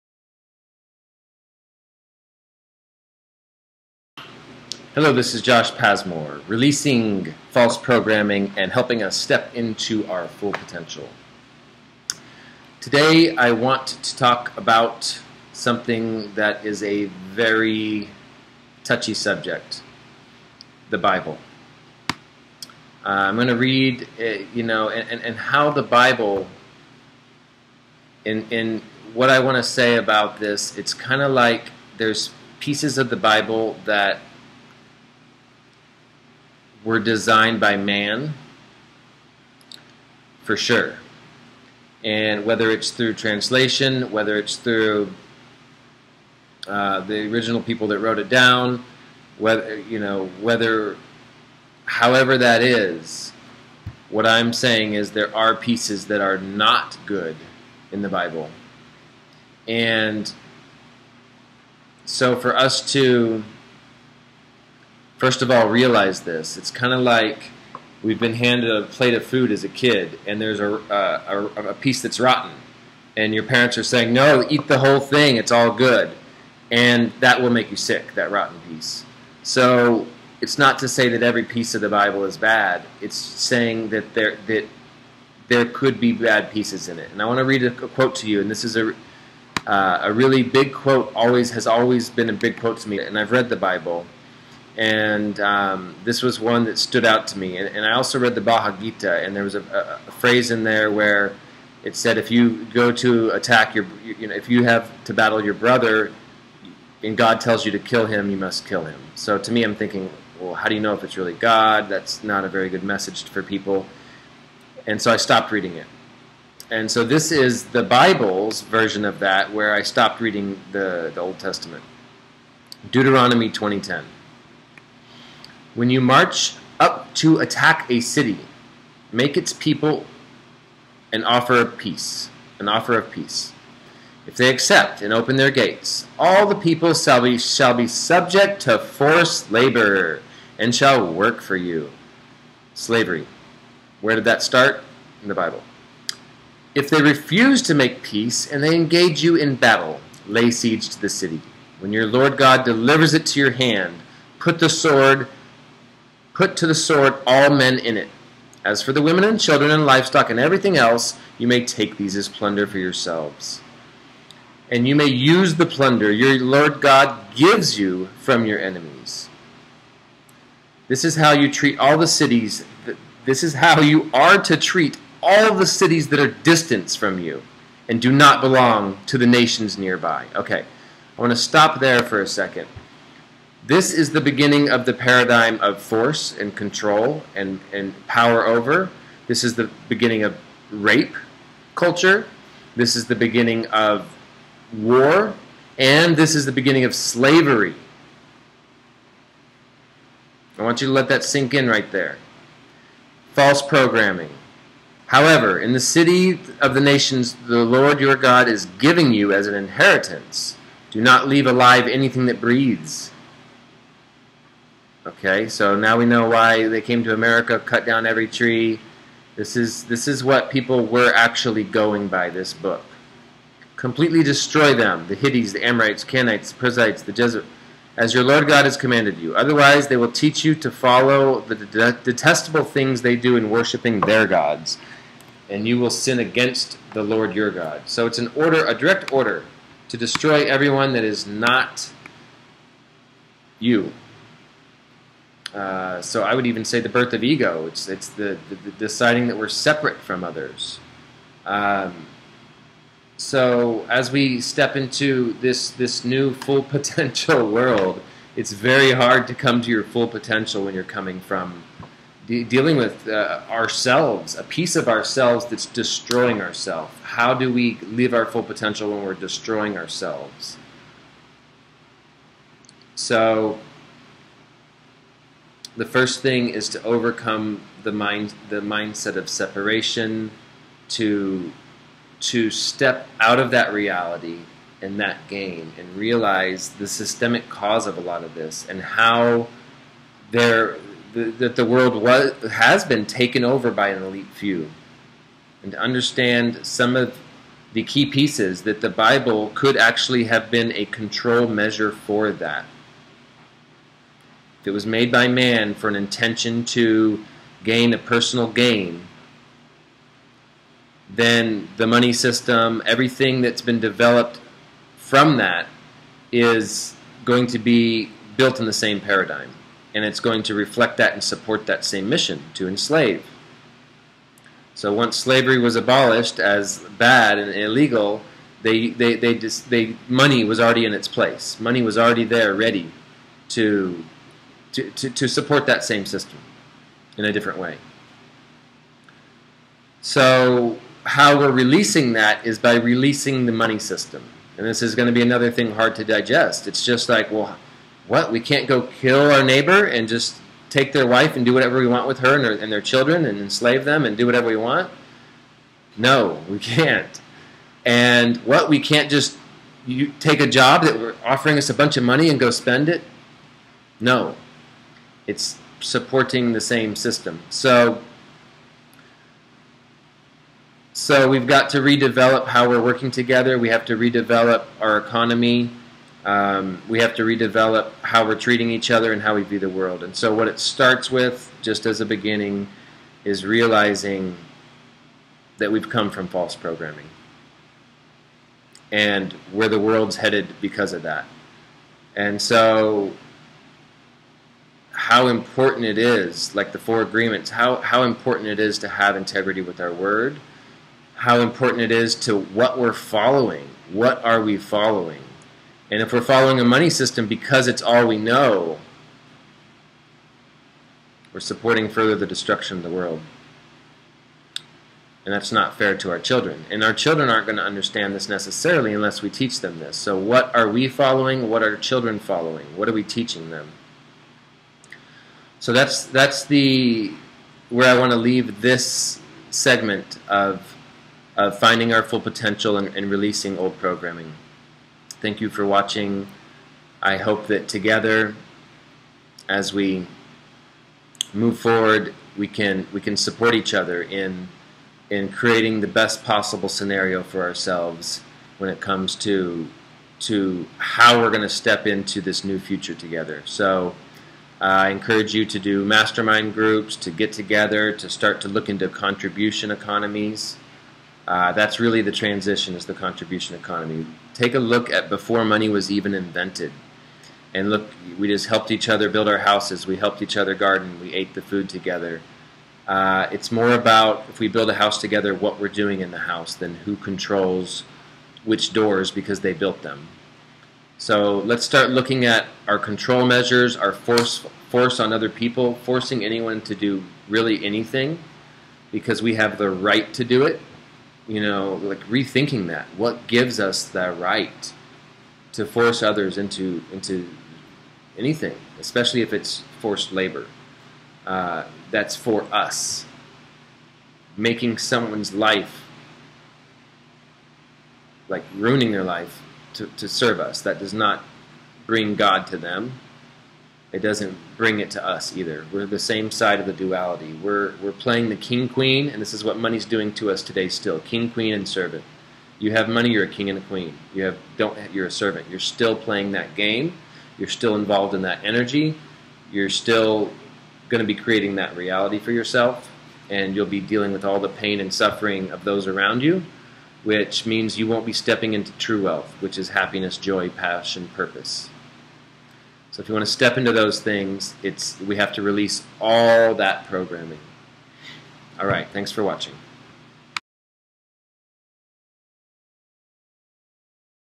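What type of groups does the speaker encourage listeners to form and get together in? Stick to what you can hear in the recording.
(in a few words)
Mastermind groups.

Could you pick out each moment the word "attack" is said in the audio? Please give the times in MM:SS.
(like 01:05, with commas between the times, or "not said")
01:43, 02:07.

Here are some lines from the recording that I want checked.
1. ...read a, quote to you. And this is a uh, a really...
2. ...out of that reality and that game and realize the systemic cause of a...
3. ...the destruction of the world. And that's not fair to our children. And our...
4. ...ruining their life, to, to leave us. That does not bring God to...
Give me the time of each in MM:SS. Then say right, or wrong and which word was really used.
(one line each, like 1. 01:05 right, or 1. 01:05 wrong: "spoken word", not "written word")
1. 01:27 right
2. 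04:43 right
3. 06:52 right
4. 08:28 wrong: "serve", not "leave".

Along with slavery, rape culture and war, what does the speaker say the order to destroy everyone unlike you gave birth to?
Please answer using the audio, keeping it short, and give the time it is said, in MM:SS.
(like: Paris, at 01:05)
Ego, at 04:06.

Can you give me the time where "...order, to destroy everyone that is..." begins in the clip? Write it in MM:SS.
03:59.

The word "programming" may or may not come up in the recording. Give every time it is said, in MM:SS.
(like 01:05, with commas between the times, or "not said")
00:07, 03:23, 06:26, 07:13, 09:06.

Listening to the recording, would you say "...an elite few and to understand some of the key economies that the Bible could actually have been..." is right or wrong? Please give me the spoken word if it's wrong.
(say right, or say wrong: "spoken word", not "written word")
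wrong: "pieces", not "economies".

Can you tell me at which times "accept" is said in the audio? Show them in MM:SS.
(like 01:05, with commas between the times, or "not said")
02:14.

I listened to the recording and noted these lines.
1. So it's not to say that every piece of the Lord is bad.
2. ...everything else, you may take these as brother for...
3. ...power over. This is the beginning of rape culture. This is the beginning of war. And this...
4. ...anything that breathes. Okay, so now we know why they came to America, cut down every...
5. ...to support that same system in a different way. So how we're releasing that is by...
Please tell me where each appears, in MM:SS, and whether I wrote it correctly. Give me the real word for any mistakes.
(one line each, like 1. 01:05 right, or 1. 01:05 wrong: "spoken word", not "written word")
1. 01:19 wrong: "Bible", not "Lord"
2. 02:40 wrong: "plunder", not "brother"
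3. 03:08 right
4. 03:31 right
5. 05:35 right.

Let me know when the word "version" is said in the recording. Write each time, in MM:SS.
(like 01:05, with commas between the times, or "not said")
01:58.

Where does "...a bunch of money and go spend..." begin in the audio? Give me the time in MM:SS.
06:01.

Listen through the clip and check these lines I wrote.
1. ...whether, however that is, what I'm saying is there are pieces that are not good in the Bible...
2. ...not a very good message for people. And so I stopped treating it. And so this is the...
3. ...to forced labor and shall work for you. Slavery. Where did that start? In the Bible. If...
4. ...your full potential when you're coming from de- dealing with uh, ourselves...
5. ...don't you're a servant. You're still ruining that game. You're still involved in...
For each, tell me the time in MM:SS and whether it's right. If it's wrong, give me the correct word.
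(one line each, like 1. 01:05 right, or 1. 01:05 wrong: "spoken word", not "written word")
1. 00:50 right
2. 01:52 wrong: "reading", not "treating"
3. 02:18 right
4. 04:19 right
5. 08:44 wrong: "playing", not "ruining".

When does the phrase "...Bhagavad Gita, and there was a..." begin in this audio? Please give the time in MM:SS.
01:38.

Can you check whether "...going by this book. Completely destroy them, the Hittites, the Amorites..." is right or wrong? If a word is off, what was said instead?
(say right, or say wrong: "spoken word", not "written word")
right.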